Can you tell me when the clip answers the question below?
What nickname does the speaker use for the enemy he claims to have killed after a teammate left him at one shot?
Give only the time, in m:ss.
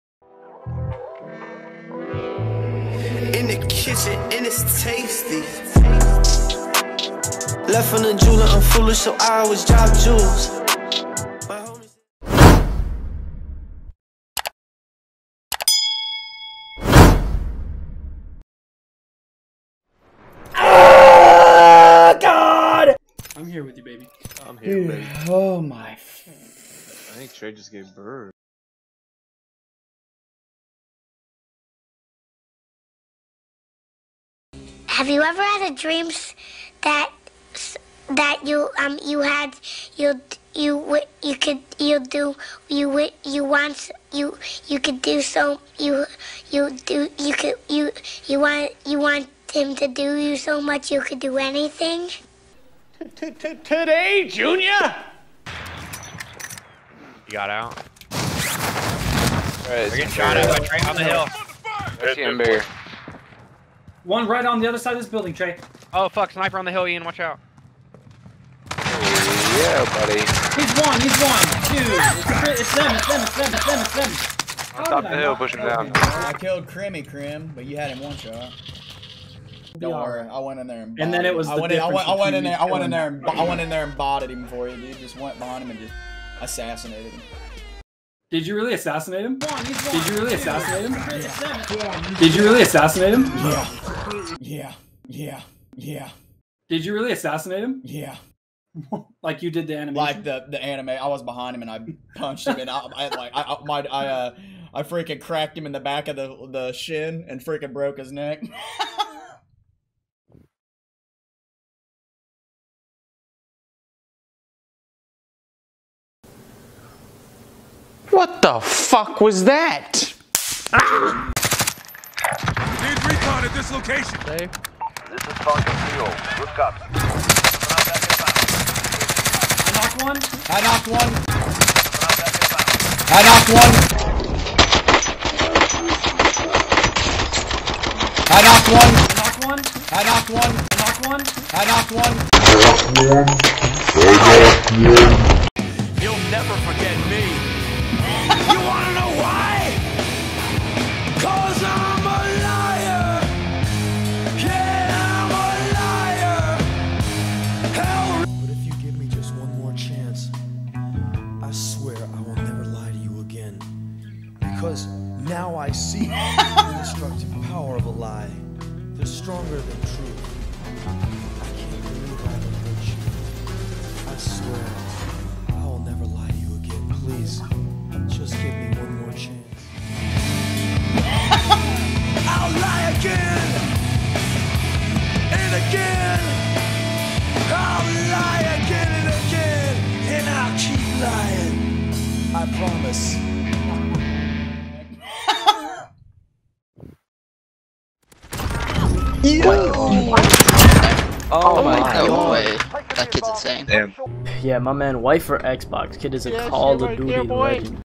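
1:16.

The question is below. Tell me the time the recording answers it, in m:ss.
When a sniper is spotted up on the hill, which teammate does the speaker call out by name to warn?
1:06.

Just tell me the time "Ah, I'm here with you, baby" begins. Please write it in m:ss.
0:20.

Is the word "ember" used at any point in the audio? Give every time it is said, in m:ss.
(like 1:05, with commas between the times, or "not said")
1:02.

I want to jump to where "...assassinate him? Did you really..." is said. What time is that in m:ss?
1:28.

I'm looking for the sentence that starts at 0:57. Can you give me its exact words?
All right, We're getting shot at by Trey on the hill.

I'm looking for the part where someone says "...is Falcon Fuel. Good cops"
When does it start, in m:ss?
2:05.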